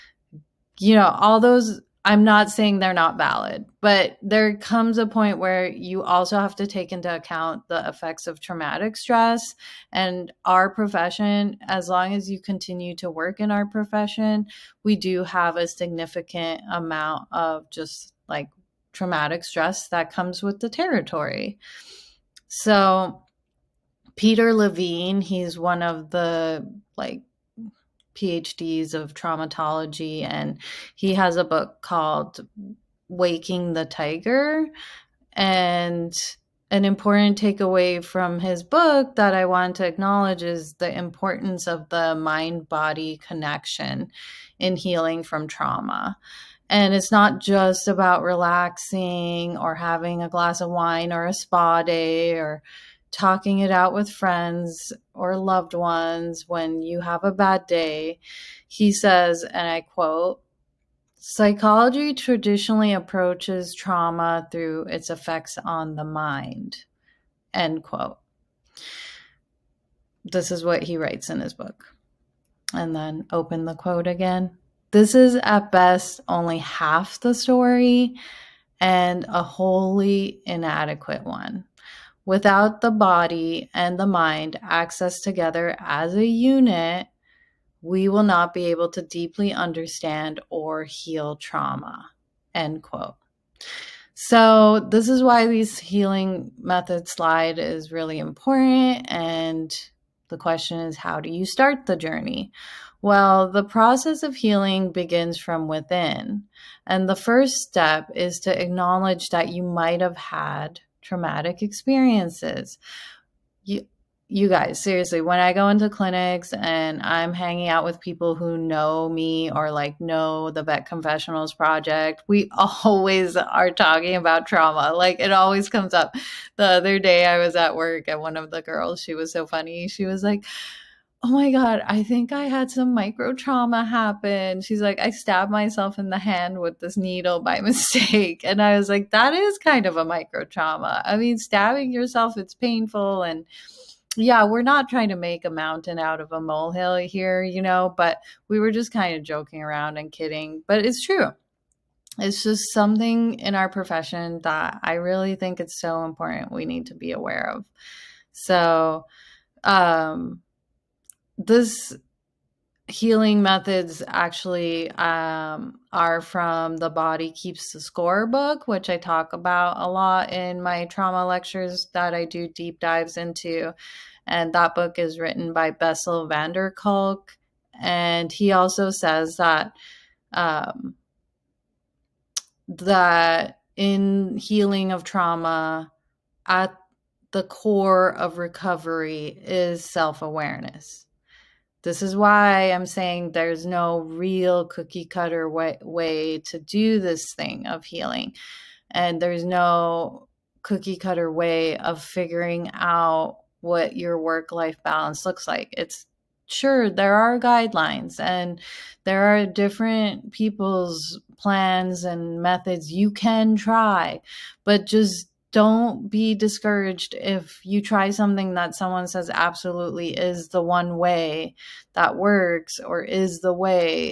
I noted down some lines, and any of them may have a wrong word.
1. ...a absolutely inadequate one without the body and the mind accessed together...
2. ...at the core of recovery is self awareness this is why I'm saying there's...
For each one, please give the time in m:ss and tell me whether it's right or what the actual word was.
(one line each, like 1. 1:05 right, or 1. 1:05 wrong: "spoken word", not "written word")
1. 1:19 wrong: "wholly", not "absolutely"
2. 3:06 right.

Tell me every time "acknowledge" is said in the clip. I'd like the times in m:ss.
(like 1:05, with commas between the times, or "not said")
0:39, 1:48.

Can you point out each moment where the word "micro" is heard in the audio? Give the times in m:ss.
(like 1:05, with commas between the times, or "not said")
2:12, 2:20.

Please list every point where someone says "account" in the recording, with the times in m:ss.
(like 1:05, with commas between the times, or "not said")
0:07.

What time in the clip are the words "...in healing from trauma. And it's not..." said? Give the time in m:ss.
0:44.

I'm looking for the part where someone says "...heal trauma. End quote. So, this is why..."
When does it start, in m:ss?
1:30.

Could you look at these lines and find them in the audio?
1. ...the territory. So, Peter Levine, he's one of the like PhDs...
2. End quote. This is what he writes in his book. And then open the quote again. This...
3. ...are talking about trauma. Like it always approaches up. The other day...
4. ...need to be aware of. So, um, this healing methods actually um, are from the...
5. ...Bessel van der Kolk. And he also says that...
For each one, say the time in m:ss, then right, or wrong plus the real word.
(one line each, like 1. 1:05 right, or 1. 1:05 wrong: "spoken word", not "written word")
1. 0:20 right
2. 1:07 right
3. 2:03 wrong: "comes", not "approaches"
4. 2:36 right
5. 2:55 right.